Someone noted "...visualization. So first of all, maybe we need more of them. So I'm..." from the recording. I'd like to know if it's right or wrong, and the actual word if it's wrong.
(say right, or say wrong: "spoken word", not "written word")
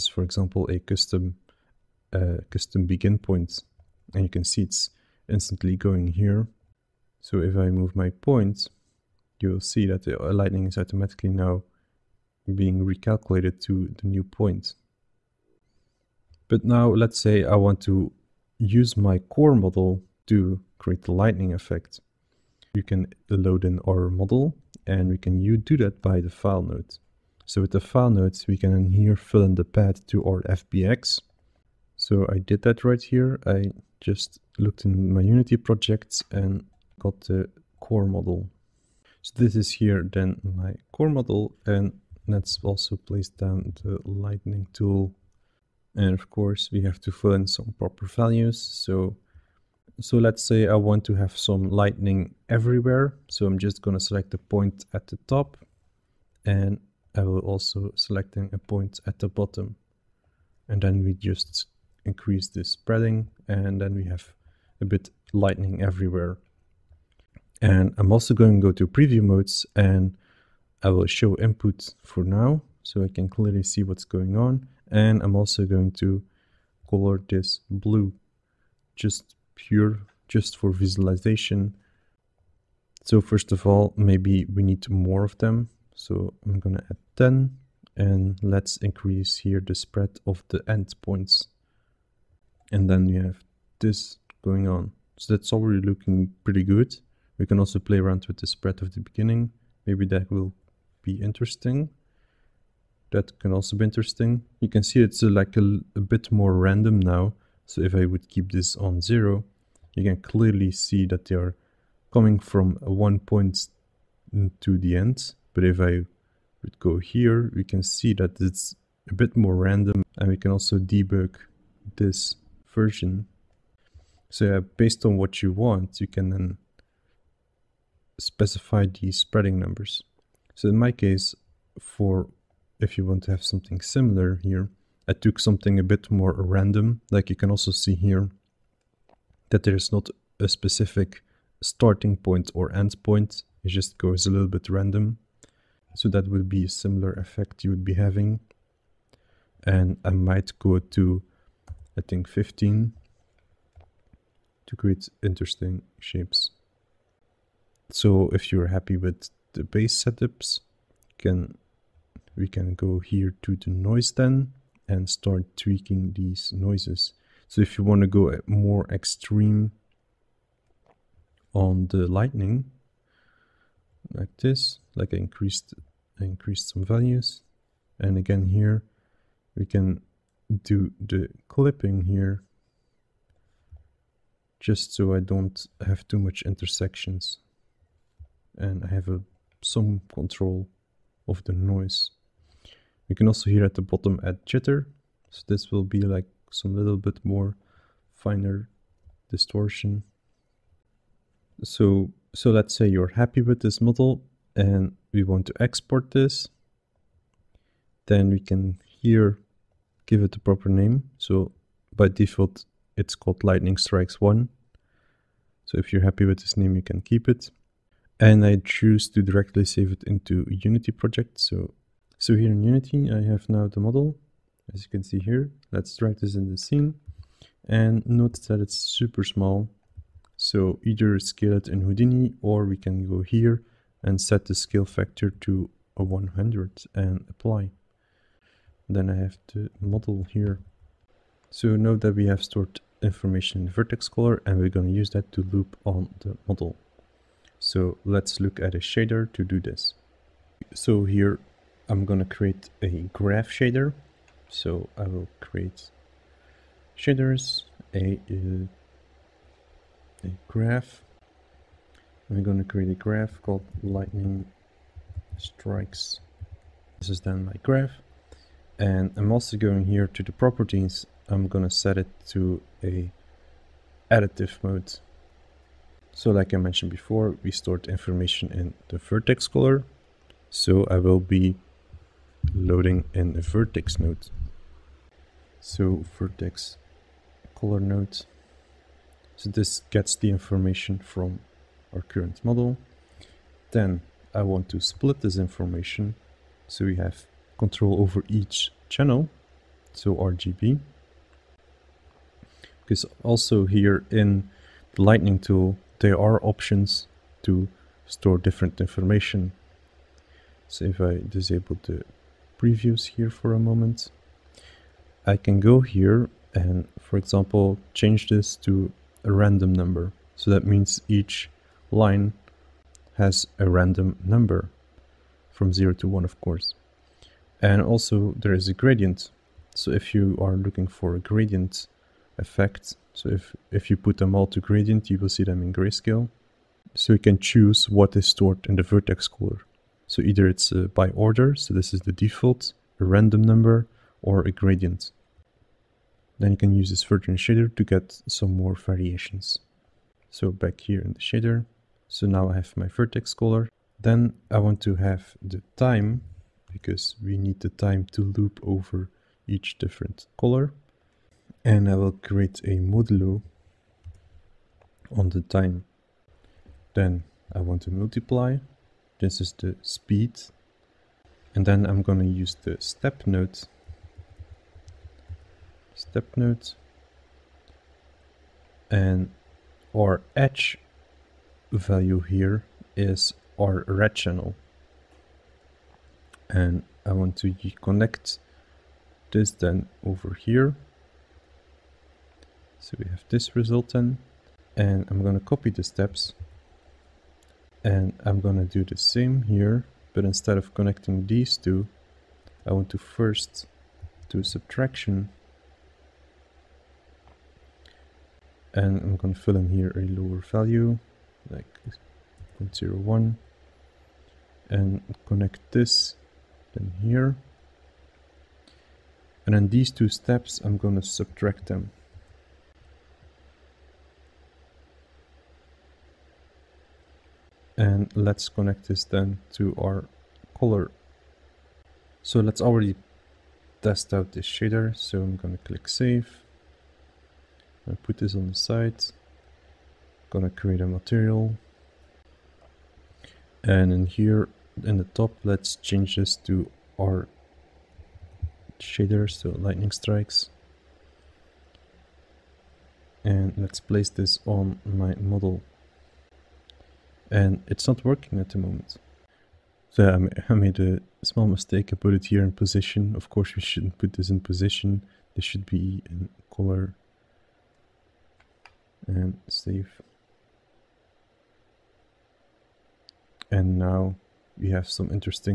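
right.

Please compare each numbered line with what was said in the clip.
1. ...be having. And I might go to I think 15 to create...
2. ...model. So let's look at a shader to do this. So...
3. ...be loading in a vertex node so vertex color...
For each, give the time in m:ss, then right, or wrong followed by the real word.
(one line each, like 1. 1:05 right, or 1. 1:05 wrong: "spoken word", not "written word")
1. 2:27 right
2. 4:06 right
3. 4:41 right.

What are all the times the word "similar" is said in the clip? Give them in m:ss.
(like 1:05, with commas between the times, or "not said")
2:13, 2:26.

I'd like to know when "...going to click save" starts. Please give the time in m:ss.
7:15.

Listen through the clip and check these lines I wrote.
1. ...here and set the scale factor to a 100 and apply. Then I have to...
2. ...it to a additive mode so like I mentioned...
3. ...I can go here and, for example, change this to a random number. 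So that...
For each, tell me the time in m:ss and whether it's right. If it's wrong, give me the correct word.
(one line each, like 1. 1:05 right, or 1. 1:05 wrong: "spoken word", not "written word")
1. 3:53 right
2. 4:31 right
3. 5:15 right.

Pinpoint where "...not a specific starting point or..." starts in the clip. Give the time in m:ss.
2:19.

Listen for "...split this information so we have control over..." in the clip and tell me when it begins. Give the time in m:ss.
4:54.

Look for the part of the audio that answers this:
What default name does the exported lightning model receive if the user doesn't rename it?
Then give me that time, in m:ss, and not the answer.
3:33.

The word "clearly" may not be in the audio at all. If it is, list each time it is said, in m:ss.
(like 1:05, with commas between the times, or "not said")
1:13, 1:50.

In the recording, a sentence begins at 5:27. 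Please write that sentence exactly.
And also there is a gradient.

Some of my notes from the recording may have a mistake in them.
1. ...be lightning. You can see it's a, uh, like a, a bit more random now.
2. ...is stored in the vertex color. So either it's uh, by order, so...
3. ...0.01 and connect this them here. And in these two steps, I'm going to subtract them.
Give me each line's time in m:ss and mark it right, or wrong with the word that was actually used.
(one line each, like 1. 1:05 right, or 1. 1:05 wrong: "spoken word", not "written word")
1. 1:43 wrong: "interesting", not "lightning"
2. 5:38 right
3. 6:52 right.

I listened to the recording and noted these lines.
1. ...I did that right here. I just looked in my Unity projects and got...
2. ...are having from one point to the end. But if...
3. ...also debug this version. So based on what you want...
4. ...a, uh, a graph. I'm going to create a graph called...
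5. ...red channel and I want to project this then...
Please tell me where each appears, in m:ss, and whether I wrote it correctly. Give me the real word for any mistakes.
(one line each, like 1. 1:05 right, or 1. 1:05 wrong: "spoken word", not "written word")
1. 0:32 right
2. 1:51 wrong: "coming", not "having"
3. 2:00 right
4. 4:17 right
5. 6:23 wrong: "connect", not "project".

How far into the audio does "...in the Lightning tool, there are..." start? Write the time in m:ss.
5:04.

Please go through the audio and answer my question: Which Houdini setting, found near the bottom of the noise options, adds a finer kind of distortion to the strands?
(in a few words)
jitter.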